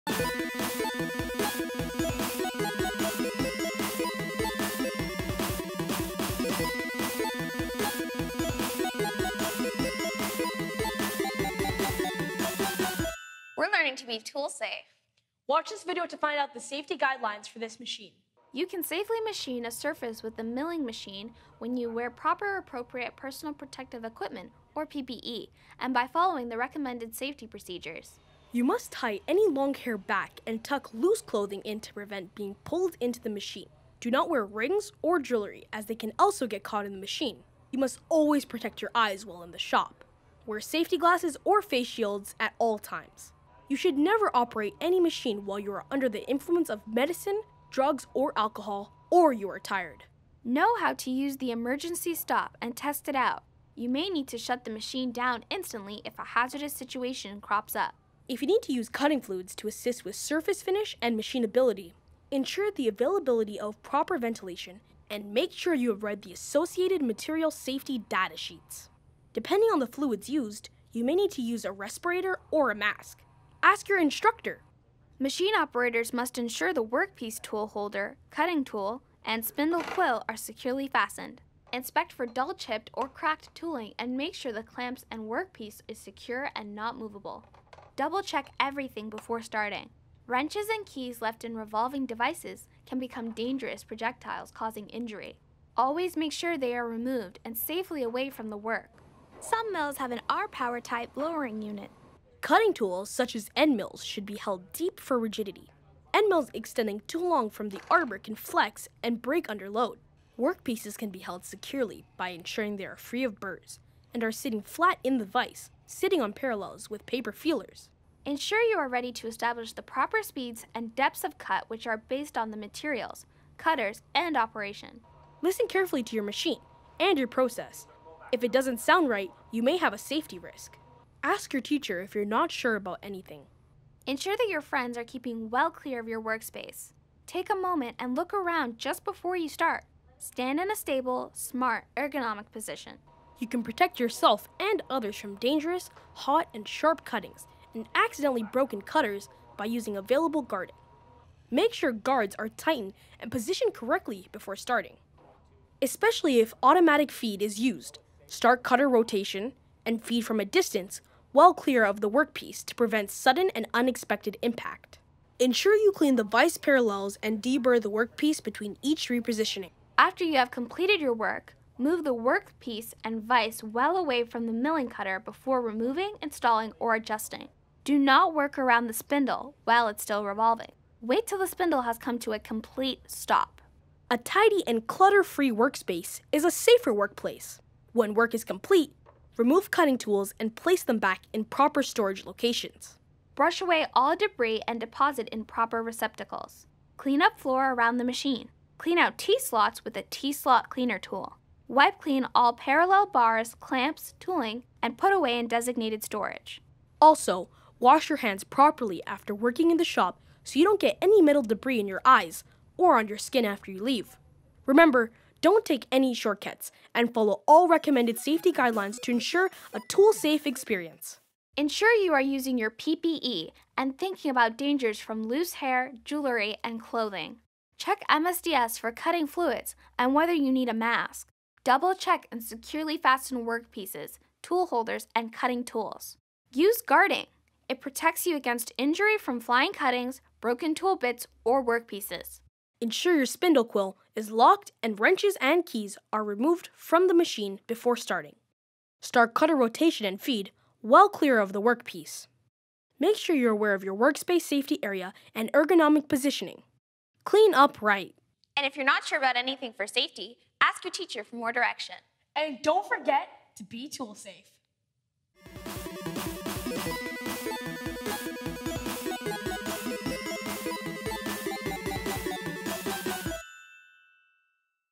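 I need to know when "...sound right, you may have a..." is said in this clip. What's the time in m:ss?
2:08.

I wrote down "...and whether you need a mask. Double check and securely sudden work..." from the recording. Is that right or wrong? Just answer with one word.
wrong.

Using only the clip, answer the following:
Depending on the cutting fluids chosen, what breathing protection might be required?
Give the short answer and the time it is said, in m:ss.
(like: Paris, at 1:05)
a respirator or a mask, at 1:11.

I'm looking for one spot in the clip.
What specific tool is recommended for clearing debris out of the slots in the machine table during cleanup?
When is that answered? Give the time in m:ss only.
3:20.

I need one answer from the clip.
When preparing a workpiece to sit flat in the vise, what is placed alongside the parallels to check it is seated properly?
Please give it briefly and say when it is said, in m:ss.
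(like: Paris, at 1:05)
paper feelers, at 1:57.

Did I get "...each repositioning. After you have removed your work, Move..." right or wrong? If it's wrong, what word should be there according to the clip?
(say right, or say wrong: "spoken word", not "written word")
wrong: "completed", not "removed".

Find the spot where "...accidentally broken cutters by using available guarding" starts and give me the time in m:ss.
2:27.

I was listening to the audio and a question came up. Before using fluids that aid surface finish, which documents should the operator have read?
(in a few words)
material safety data sheets.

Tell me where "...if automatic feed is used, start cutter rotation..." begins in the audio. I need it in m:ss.
2:36.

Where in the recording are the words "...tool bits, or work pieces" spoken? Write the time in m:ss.
4:00.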